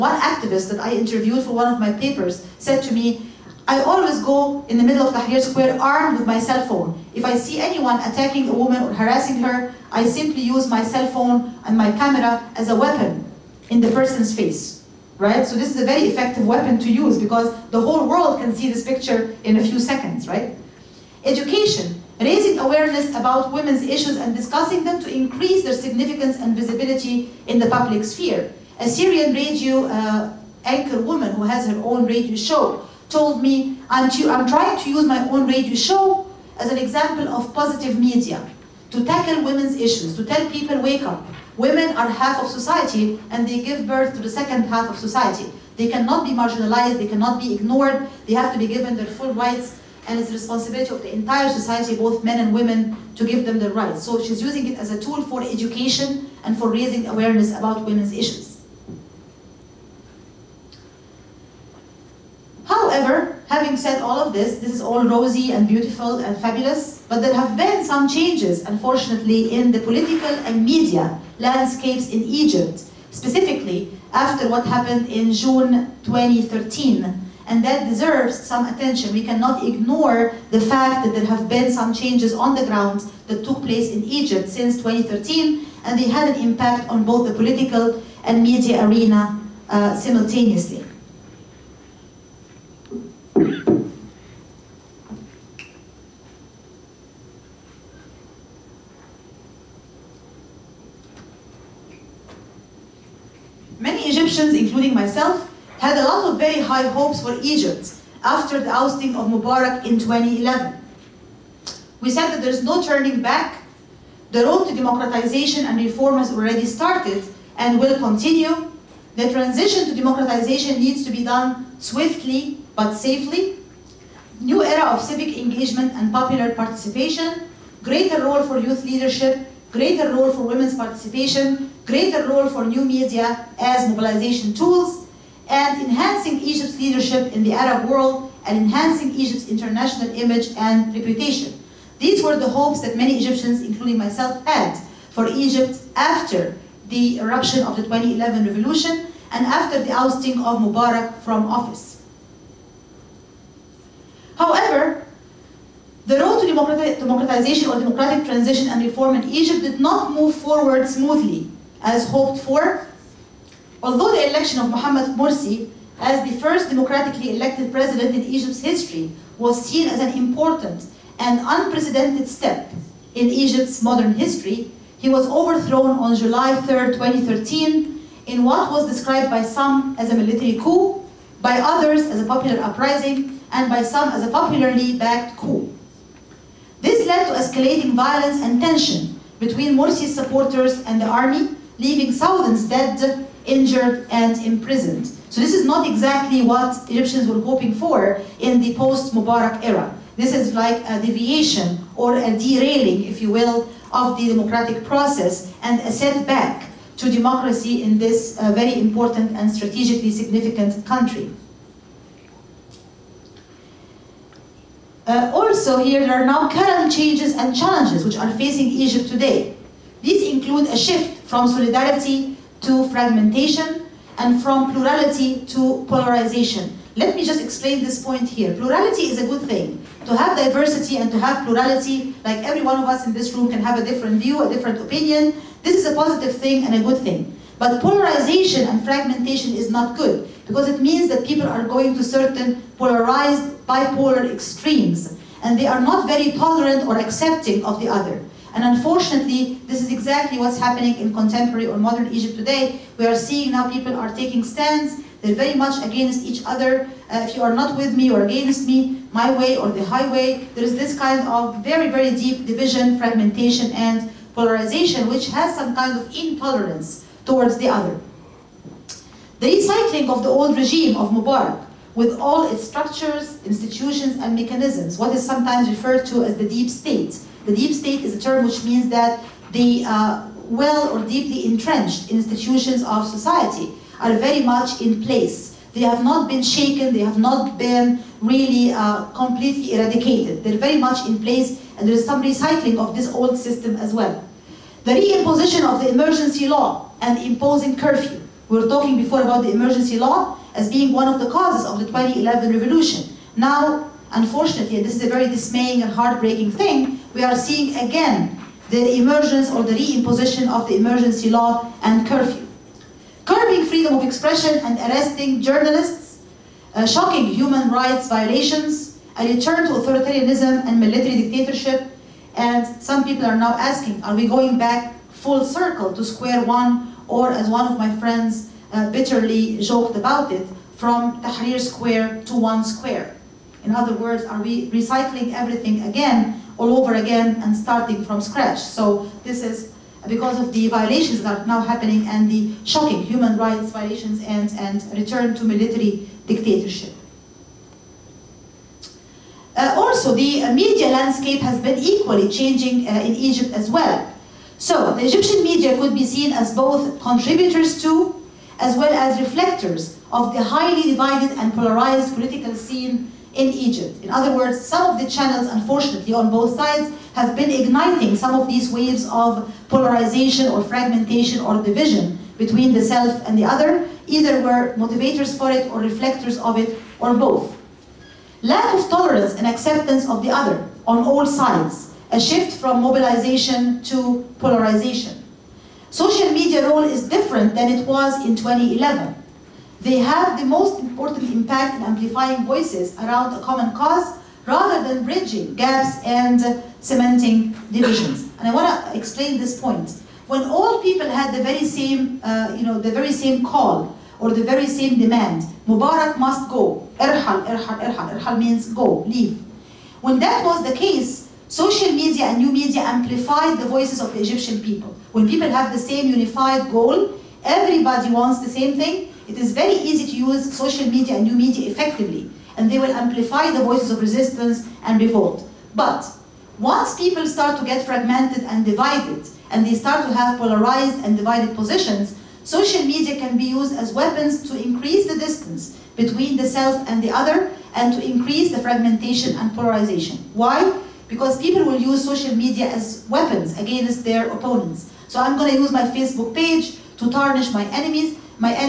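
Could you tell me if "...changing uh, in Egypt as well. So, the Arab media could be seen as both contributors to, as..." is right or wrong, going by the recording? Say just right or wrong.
wrong.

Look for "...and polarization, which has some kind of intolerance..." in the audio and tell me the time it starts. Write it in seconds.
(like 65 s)
263 s.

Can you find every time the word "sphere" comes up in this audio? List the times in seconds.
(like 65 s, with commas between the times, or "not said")
28 s.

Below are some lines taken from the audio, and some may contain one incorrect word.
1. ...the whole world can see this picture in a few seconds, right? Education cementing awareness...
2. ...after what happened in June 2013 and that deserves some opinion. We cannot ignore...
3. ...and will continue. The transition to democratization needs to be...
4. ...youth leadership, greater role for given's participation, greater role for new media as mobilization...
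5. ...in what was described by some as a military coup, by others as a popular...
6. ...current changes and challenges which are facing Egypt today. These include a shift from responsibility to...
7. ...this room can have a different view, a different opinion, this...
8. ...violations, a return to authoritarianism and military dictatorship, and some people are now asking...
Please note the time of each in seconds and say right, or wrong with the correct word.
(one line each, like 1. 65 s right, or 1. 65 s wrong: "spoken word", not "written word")
1. 17 s wrong: "raising", not "cementing"
2. 74 s wrong: "attention", not "opinion"
3. 117 s right
4. 128 s wrong: "women", not "given"
5. 178 s right
6. 216 s wrong: "solidarity", not "responsibility"
7. 233 s right
8. 318 s right.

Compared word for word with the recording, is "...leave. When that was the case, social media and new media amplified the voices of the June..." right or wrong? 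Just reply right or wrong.
wrong.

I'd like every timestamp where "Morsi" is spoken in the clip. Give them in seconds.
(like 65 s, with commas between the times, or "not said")
165 s, 189 s.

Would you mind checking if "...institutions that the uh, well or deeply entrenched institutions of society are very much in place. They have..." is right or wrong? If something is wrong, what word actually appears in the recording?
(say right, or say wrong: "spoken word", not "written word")
wrong: "means", not "institutions".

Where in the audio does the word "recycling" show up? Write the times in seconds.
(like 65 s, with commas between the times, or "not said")
269 s, 292 s, 334 s.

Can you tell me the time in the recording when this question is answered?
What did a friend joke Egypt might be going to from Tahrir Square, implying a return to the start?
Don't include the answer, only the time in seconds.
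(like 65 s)
332 s.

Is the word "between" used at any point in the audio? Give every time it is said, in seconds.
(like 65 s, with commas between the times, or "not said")
189 s, 372 s, 435 s.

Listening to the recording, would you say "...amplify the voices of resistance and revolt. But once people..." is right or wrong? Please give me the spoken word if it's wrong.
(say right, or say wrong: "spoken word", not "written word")
right.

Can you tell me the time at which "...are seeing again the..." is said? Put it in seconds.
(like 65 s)
307 s.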